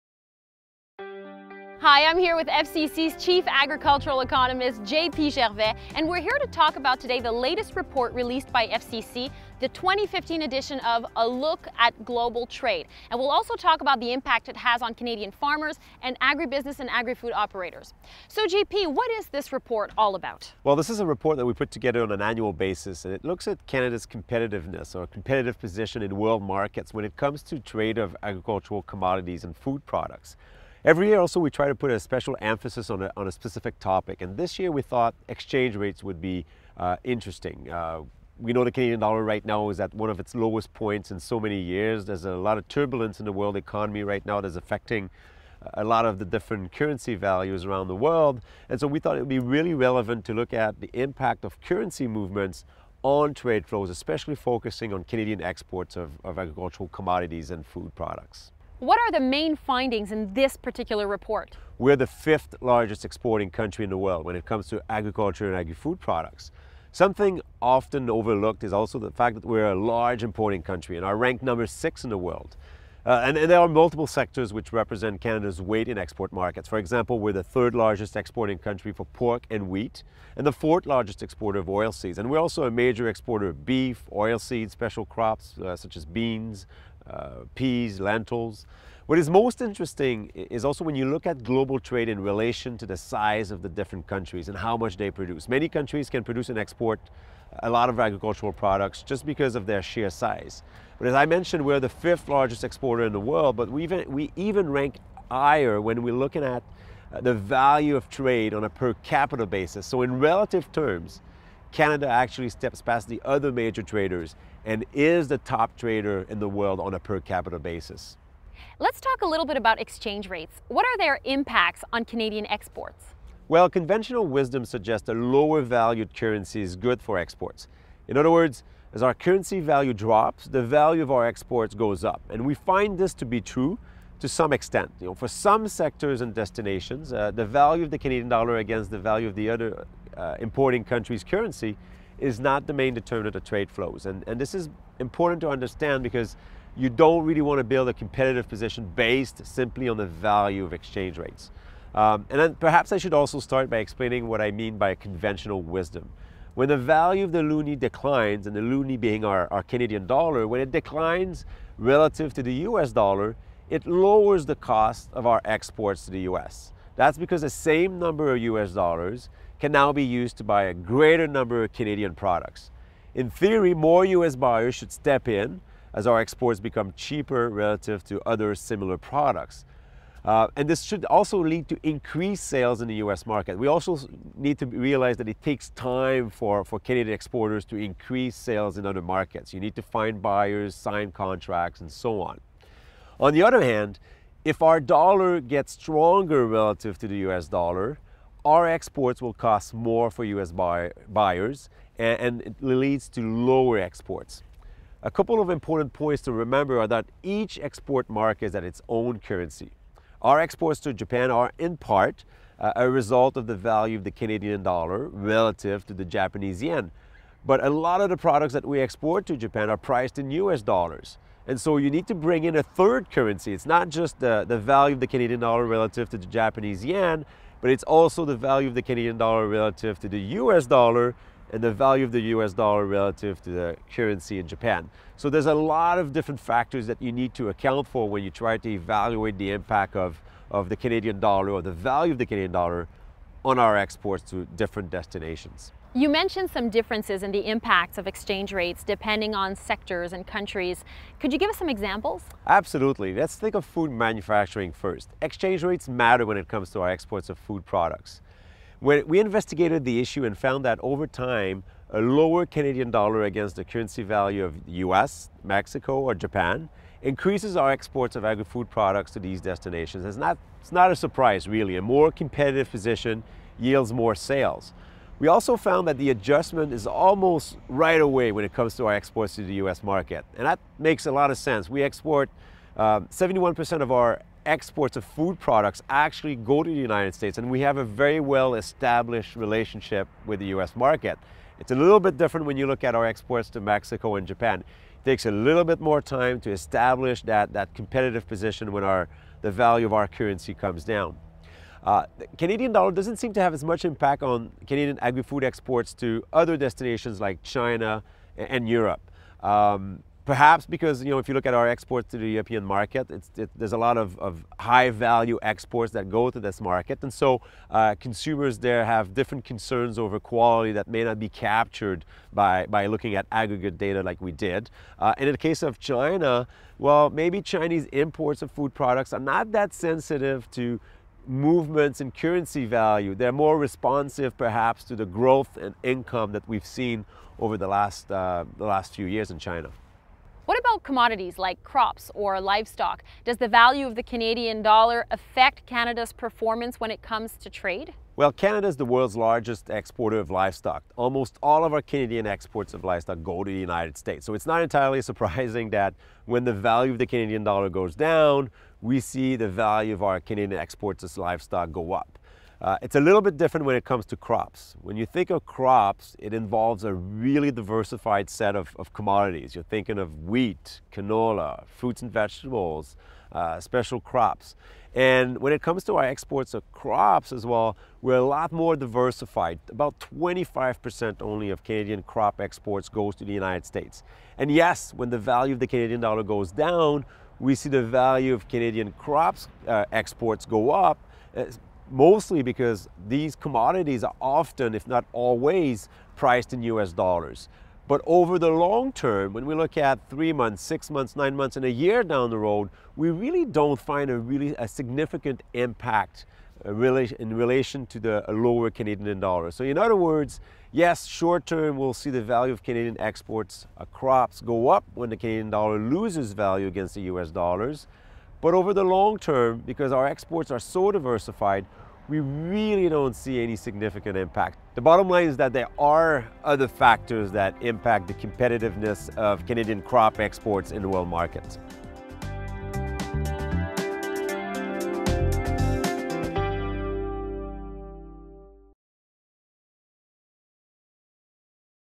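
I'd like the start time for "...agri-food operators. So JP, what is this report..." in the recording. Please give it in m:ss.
0:16.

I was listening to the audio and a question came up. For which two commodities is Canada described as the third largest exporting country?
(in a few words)
Pork and wheat.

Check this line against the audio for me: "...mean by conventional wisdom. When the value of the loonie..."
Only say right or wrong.
right.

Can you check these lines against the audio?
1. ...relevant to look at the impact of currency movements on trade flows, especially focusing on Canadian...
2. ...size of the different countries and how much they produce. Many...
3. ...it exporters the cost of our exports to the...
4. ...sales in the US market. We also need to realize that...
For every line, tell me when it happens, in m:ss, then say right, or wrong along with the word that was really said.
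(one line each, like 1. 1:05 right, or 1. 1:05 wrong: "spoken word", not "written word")
1. 0:49 right
2. 1:32 right
3. 2:43 wrong: "lowers", not "exporters"
4. 3:02 right.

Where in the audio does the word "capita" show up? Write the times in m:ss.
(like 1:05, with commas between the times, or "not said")
1:48, 1:57.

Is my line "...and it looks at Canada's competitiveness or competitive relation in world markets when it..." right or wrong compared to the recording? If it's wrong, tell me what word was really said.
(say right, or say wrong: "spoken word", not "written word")
wrong: "position", not "relation".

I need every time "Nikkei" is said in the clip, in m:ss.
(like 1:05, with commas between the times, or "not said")
not said.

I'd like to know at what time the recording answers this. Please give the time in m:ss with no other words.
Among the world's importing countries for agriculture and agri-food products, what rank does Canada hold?
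1:11.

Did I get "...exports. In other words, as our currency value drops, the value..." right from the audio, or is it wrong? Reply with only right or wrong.
right.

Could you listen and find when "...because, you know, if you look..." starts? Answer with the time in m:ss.
5:10.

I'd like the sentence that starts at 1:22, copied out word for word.
And we're also a major exporter of beef, oilseeds, special crops uh, such as beans, uh, peas, lentils.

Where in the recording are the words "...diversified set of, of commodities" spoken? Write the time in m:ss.
6:07.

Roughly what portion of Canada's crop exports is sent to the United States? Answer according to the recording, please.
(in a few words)
25%.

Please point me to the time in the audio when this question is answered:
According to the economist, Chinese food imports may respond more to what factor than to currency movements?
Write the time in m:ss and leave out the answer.
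5:35.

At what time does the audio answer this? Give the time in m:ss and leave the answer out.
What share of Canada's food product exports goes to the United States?
4:42.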